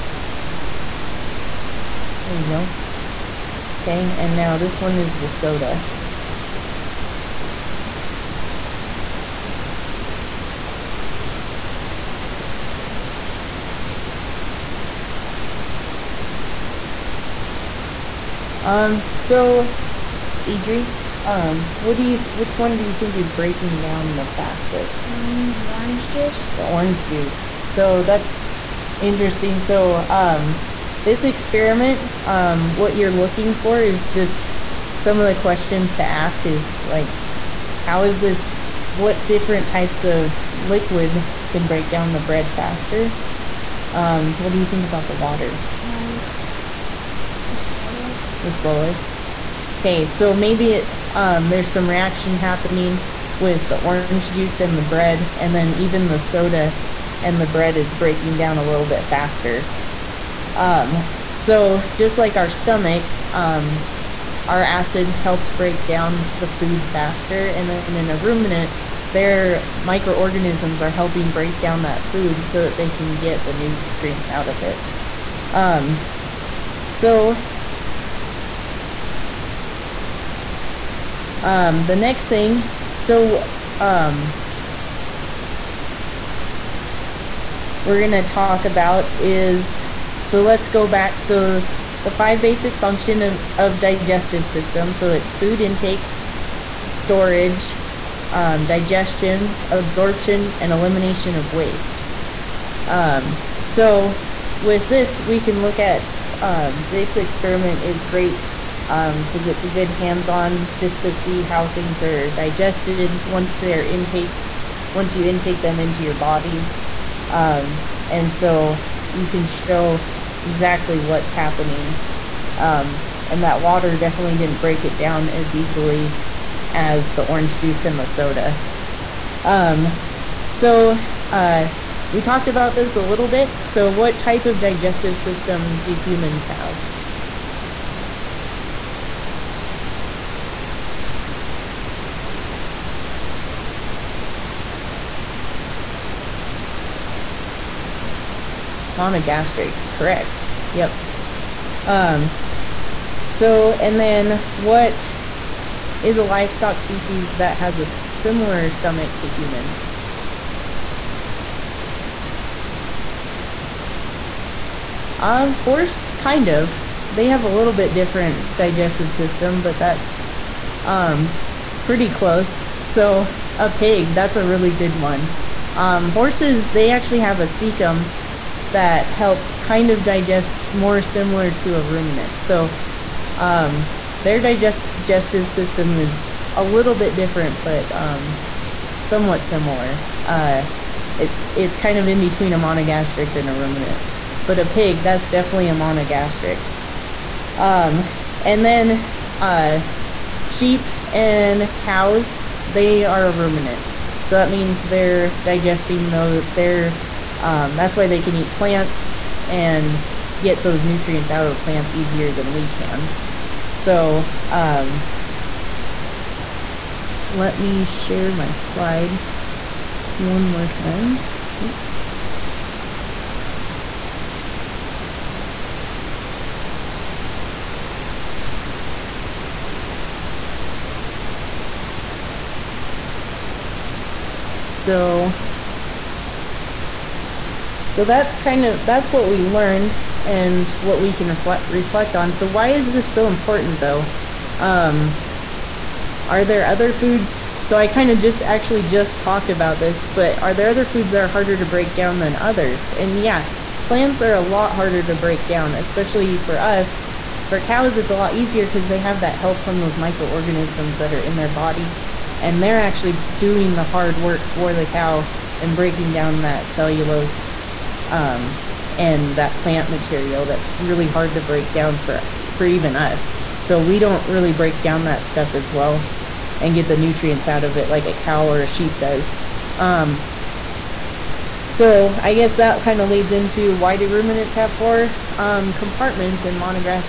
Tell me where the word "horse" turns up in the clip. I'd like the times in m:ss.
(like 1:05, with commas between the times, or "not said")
2:45, 2:56.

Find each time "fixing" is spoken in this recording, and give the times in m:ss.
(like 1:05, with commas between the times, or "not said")
not said.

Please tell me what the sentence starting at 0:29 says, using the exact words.
So, um, this experiment, um, what you're looking for is just some of the questions to ask is like, how is this?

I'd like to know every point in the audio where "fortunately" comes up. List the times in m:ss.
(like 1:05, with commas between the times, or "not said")
not said.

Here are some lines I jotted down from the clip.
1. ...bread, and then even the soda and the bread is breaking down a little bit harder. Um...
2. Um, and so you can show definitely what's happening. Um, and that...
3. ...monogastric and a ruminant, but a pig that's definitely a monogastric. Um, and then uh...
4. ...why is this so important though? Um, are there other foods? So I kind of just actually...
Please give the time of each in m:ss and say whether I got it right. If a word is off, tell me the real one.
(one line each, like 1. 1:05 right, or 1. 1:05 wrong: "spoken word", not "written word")
1. 0:54 wrong: "faster", not "harder"
2. 1:57 wrong: "exactly", not "definitely"
3. 3:12 right
4. 4:02 right.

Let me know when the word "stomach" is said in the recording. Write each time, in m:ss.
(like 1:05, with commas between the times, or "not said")
1:02, 2:38.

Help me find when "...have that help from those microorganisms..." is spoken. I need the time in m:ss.
4:18.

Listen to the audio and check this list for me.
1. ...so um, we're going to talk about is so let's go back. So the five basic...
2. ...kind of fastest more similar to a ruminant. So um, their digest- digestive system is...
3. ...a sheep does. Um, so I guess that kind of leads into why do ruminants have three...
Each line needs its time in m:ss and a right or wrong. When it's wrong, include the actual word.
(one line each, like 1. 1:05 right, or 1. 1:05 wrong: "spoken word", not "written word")
1. 1:22 right
2. 2:59 wrong: "digest", not "fastest"
3. 4:38 wrong: "four", not "three".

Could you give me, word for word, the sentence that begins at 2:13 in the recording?
So what type of digestive system do humans have?